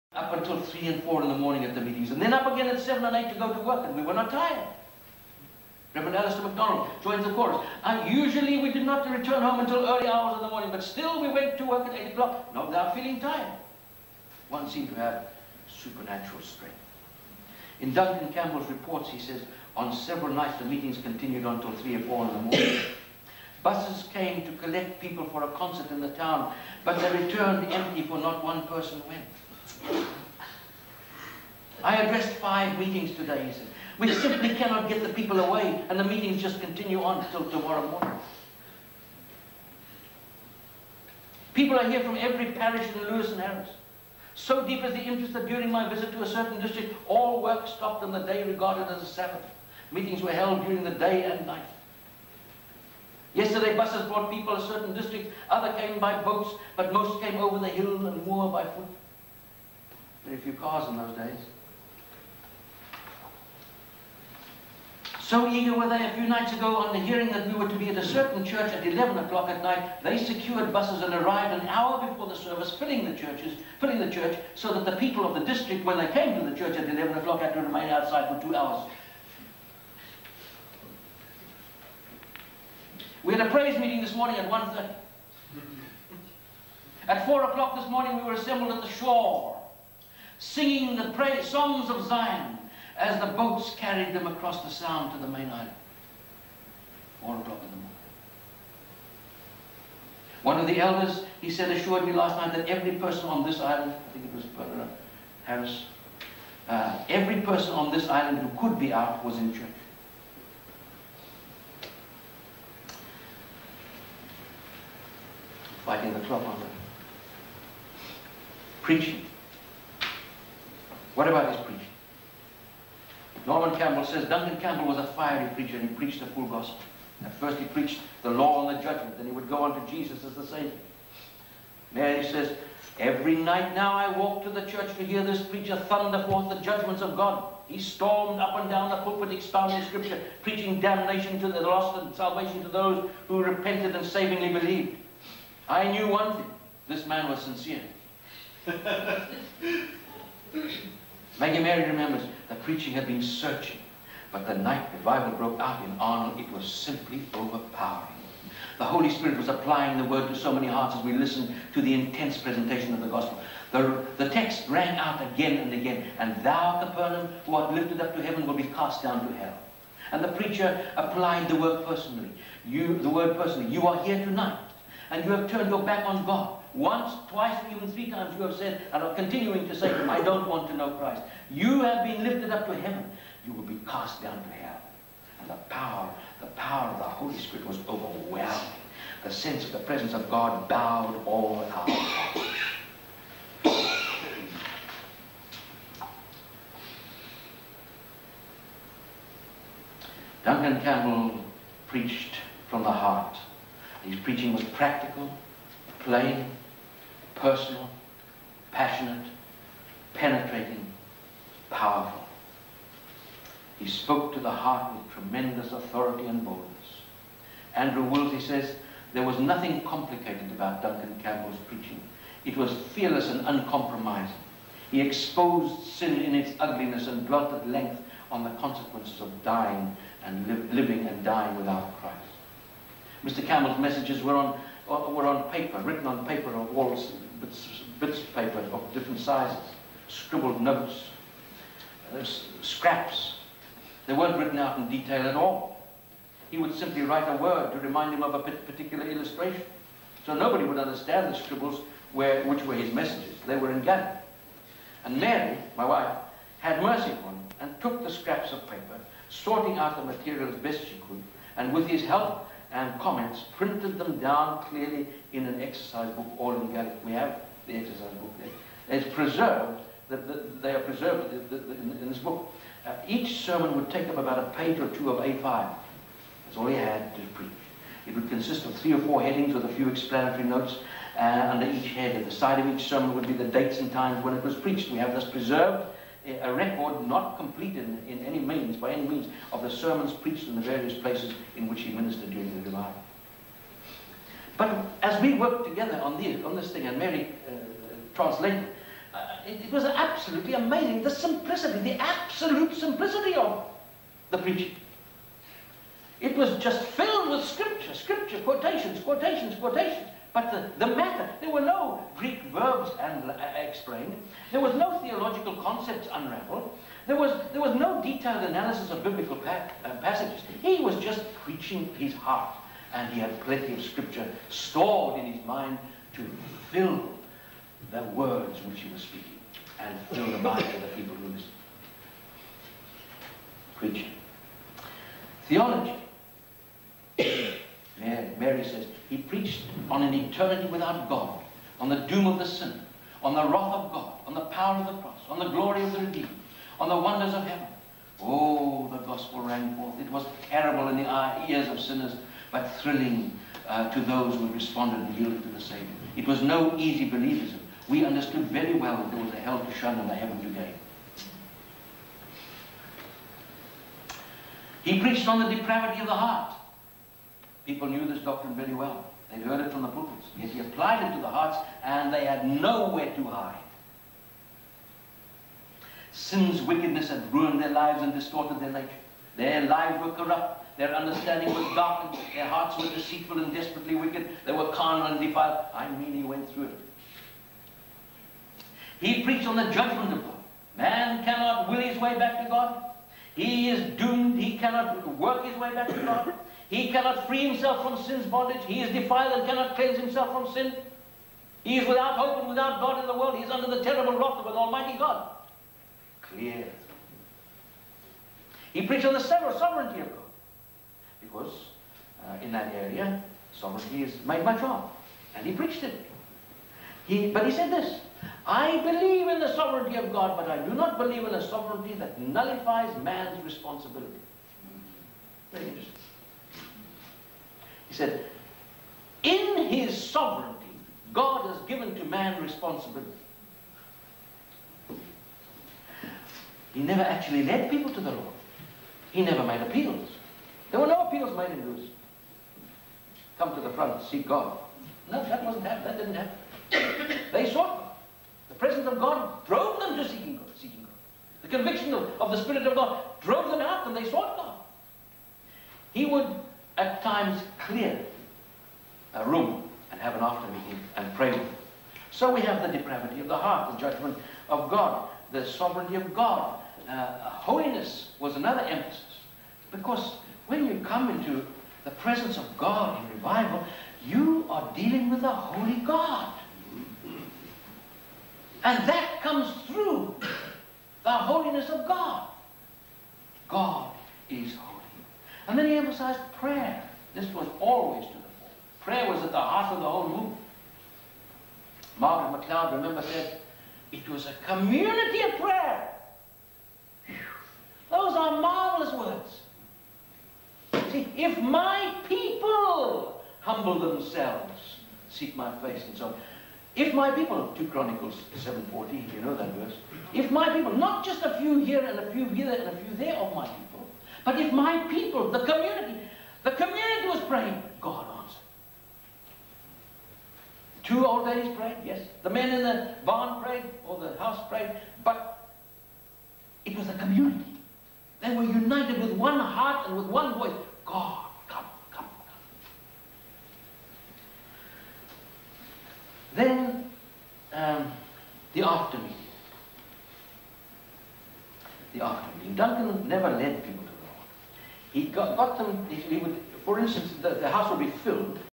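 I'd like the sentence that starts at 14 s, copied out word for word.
One seemed to have supernatural strength.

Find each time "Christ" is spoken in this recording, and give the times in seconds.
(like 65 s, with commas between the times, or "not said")
180 s, 232 s.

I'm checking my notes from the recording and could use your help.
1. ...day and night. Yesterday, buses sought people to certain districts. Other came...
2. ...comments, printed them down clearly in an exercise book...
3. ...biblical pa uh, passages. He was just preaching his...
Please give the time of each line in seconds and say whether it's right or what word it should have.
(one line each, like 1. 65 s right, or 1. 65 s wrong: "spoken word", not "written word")
1. 50 s wrong: "brought", not "sought"
2. 262 s right
3. 319 s right.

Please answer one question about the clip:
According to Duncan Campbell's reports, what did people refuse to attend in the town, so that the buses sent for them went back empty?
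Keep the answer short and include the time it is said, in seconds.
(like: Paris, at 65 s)
A concert, at 25 s.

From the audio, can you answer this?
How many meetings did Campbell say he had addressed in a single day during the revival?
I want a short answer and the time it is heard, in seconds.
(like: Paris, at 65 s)
5, at 32 s.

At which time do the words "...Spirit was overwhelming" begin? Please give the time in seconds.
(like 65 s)
187 s.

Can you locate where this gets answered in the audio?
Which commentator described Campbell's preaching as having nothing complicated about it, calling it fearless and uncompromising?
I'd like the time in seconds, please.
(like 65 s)
217 s.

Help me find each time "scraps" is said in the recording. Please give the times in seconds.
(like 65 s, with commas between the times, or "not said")
242 s, 258 s.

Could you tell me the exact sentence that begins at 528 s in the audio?
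They were united with one heart and with one voice.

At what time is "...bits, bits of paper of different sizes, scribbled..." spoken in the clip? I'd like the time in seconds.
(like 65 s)
237 s.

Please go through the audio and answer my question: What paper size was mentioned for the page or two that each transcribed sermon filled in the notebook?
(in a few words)
A5.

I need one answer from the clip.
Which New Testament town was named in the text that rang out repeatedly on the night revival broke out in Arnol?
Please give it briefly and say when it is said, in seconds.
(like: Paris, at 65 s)
Capernaum, at 166 s.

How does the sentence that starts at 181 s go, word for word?
You have been lifted up to heaven.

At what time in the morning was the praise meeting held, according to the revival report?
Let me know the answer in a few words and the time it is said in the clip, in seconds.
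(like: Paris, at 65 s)
1:30, at 84 s.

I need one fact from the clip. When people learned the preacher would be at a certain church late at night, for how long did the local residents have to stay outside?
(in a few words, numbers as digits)
2 hours.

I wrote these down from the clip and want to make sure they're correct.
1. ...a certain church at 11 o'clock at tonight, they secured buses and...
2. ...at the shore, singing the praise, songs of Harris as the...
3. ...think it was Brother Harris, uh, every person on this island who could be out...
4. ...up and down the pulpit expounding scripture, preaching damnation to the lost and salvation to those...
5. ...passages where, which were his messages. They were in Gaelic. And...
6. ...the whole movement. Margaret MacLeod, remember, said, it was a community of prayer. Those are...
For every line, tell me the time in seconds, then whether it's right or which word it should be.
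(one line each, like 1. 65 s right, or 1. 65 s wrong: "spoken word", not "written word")
1. 67 s wrong: "night", not "tonight"
2. 88 s wrong: "Zion", not "Harris"
3. 104 s right
4. 138 s right
5. 251 s wrong: "scribbles", not "passages"
6. 489 s right.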